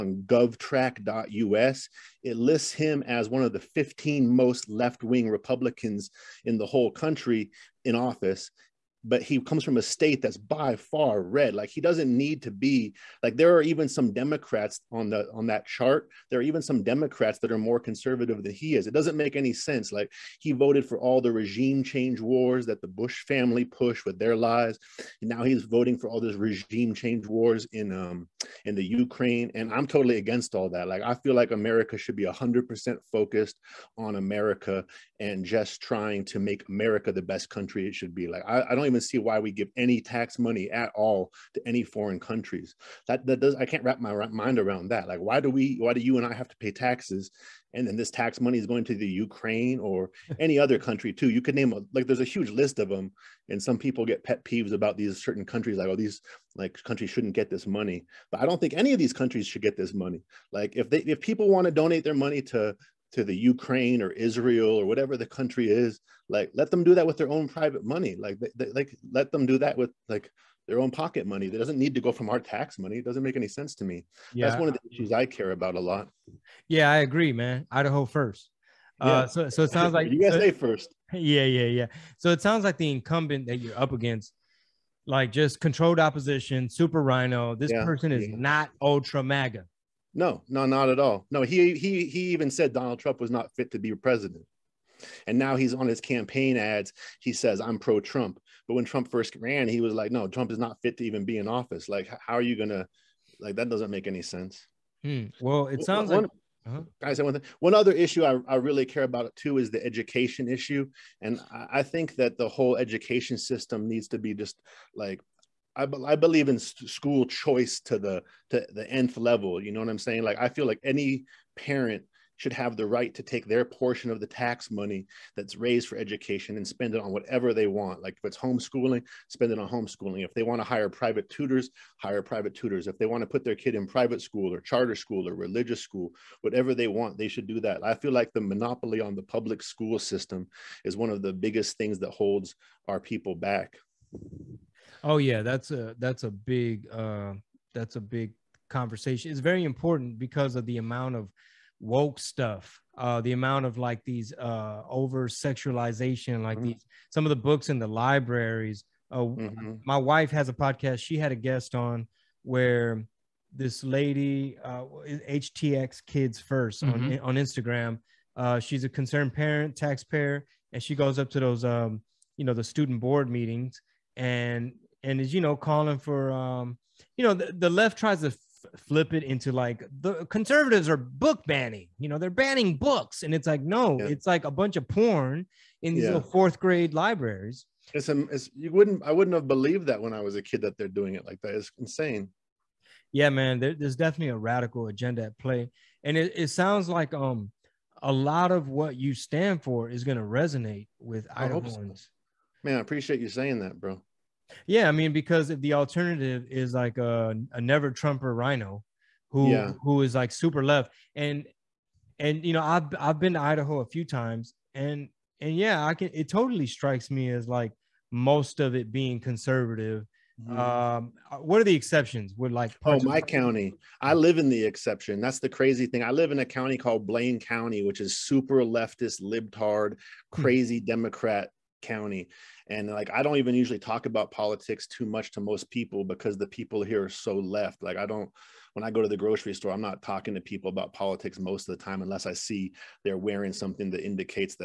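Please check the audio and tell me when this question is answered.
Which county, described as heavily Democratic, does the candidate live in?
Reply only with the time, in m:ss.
3:47.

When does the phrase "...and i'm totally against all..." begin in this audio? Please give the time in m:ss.
0:29.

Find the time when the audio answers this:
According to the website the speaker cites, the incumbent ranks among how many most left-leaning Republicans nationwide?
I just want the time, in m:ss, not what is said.
0:03.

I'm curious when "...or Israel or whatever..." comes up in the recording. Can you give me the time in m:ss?
1:04.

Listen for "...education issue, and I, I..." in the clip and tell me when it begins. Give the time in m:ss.
1:49.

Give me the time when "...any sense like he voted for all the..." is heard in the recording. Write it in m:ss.
0:19.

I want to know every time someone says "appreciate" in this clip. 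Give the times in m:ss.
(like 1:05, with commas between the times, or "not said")
3:22.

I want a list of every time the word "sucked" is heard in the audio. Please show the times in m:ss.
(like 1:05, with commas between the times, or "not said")
not said.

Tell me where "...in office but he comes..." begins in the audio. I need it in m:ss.
0:07.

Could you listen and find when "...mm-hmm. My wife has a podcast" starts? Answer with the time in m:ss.
2:39.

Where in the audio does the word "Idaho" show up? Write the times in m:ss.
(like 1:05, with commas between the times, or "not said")
1:17, 3:33.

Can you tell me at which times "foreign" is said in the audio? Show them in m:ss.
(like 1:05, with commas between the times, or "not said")
0:41.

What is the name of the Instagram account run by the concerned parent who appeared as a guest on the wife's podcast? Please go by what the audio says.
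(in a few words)
HTX Kids 1st.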